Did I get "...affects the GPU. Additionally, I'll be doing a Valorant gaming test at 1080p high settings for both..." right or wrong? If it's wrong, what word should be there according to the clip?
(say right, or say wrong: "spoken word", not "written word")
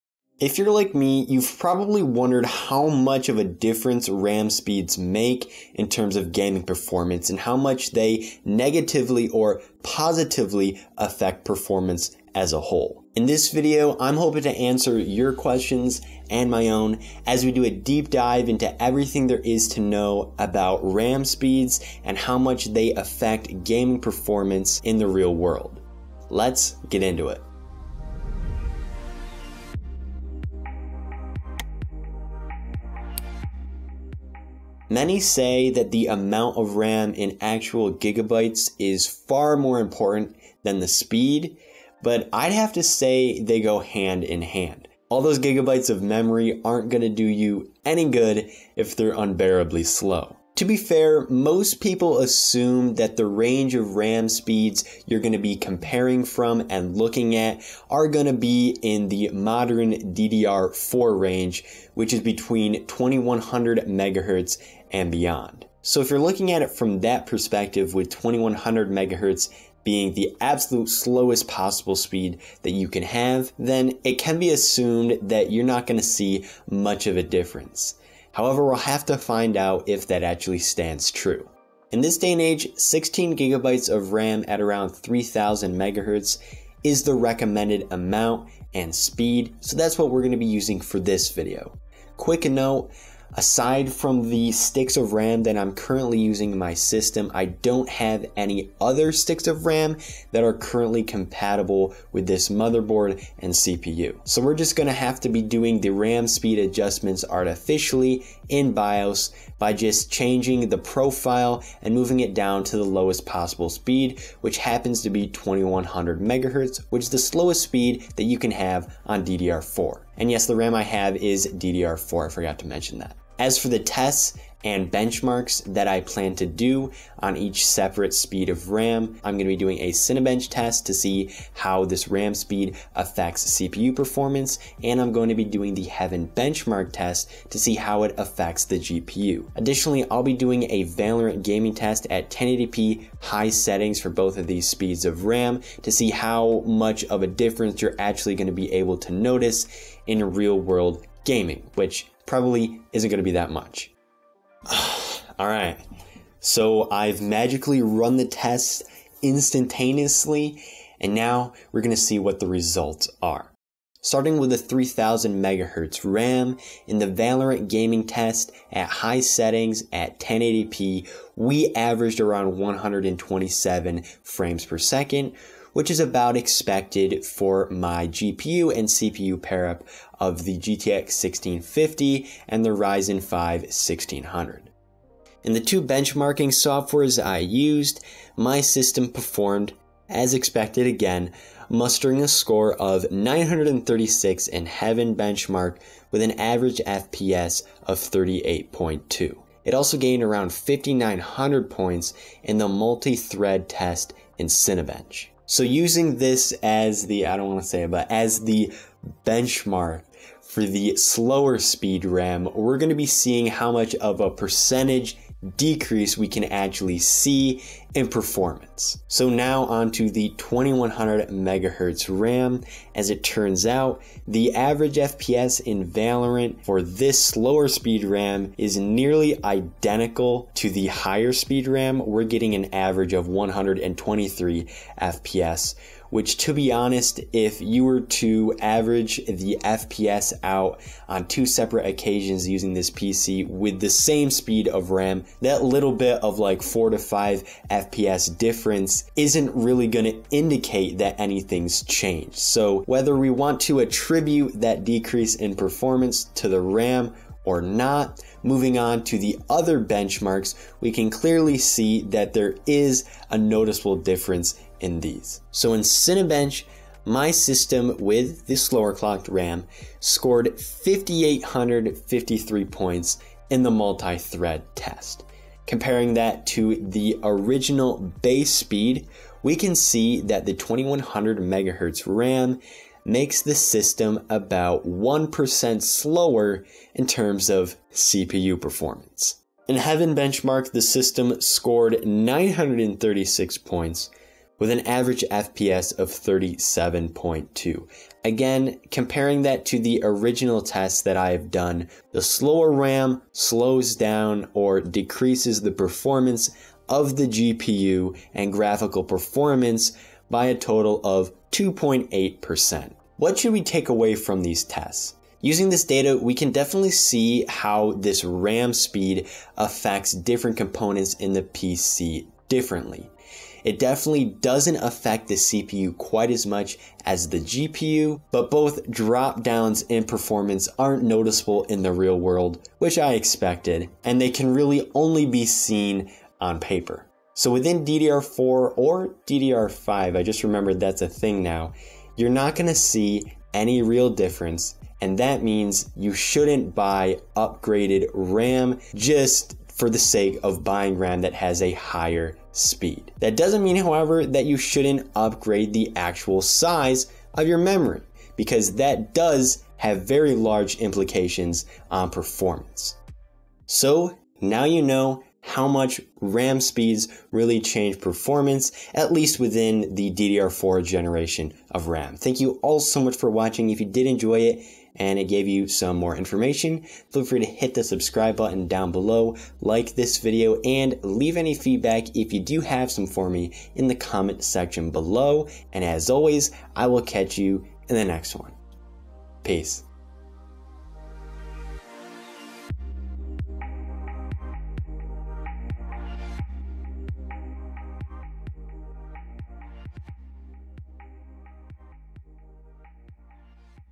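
right.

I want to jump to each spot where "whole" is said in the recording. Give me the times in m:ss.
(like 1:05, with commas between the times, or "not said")
0:12.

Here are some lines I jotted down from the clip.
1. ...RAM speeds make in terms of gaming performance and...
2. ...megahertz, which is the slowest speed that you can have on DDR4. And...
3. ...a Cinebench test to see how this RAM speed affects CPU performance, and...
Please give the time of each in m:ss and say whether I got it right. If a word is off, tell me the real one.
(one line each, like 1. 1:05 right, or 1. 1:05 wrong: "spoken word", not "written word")
1. 0:04 right
2. 1:56 right
3. 2:09 right.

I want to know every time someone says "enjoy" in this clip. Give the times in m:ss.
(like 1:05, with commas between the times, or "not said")
6:14.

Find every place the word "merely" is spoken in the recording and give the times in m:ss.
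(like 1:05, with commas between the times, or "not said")
not said.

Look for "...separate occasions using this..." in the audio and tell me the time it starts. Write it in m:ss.
4:01.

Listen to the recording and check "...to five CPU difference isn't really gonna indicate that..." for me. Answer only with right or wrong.
wrong.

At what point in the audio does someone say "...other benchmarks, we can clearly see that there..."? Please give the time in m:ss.
4:19.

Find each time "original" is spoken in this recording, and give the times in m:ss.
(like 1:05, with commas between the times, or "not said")
4:37, 5:00.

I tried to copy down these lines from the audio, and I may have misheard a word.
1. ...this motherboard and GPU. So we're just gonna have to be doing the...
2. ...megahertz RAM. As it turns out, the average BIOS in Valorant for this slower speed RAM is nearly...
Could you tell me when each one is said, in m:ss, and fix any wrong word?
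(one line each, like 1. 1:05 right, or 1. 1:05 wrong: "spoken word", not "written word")
1. 1:42 wrong: "CPU", not "GPU"
2. 3:41 wrong: "FPS", not "BIOS".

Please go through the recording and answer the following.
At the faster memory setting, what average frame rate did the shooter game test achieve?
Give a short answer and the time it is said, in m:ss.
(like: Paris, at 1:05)
127, at 2:52.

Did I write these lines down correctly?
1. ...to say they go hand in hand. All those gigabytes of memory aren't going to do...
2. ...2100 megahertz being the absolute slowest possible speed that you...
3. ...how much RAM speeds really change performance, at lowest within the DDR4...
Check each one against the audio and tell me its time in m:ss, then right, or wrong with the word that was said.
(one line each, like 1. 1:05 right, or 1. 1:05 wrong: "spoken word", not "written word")
1. 0:42 right
2. 1:08 right
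3. 6:05 wrong: "least", not "lowest".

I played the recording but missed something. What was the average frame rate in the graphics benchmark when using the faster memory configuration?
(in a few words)
38.2.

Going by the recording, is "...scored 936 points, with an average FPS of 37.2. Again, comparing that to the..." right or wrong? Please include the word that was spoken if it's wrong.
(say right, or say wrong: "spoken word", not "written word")
right.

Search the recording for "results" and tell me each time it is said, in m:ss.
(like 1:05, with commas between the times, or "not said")
2:42.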